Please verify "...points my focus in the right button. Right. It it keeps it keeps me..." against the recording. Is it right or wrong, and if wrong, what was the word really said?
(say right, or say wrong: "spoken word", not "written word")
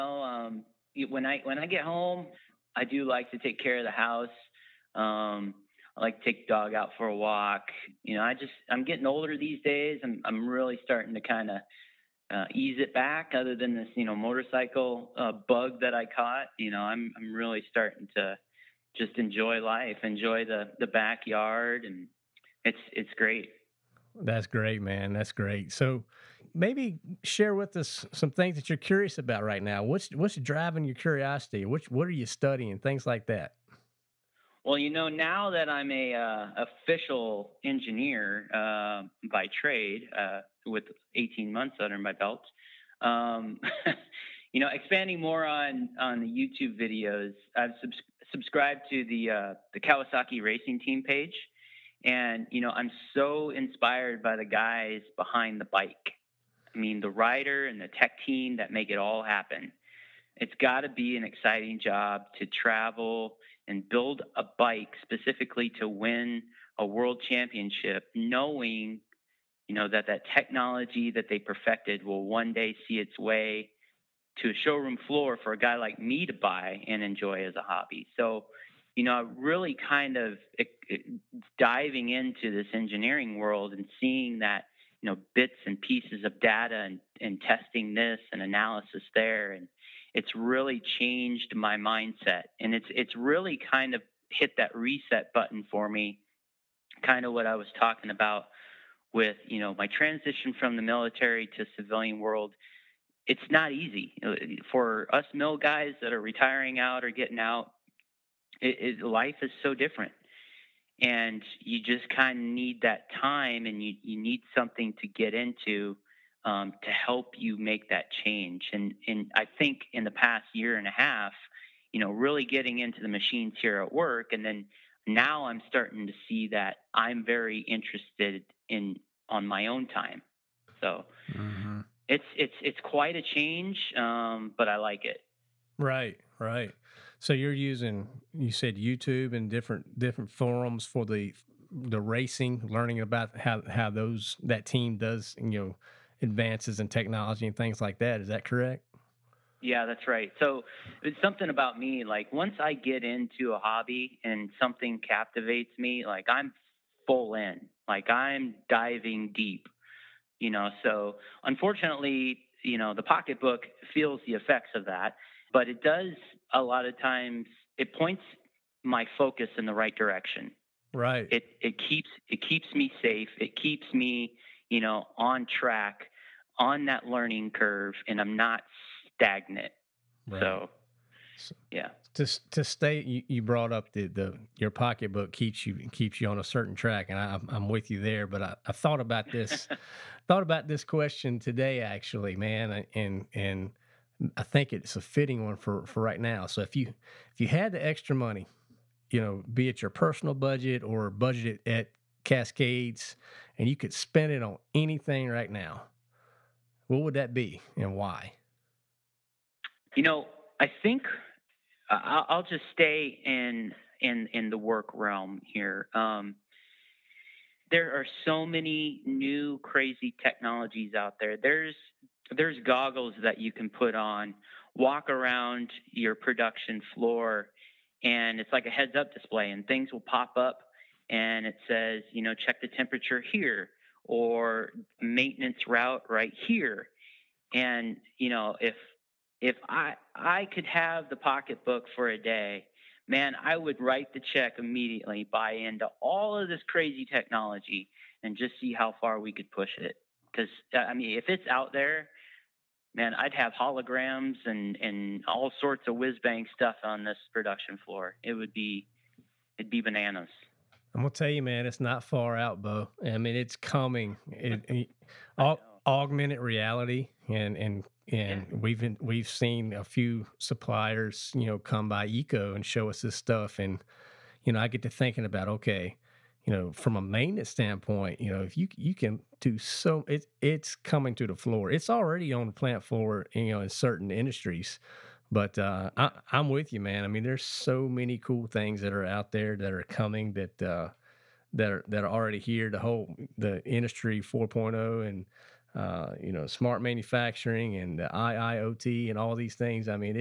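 wrong: "direction", not "button".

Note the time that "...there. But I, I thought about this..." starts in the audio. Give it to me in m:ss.
3:07.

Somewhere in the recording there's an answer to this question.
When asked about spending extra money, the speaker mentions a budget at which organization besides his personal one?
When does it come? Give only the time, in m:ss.
3:22.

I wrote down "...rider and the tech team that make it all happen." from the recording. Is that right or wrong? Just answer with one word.
right.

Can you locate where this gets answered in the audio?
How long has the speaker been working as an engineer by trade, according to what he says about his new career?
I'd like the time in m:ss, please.
0:41.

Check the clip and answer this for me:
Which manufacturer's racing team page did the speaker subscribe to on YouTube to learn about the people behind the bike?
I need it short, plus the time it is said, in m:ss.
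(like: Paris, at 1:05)
Kawasaki, at 0:49.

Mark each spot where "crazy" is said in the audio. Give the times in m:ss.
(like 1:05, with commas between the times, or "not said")
3:39, 4:06.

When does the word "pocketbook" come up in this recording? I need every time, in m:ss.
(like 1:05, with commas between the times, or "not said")
2:43, 3:04, 4:01.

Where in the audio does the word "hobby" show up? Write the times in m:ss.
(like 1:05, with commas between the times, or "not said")
1:17, 2:33.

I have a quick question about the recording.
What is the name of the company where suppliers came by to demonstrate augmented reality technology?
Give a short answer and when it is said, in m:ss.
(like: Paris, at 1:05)
EECO, at 4:32.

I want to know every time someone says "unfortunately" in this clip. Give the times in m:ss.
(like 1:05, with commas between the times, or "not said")
2:41.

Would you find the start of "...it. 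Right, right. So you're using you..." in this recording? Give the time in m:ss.
2:15.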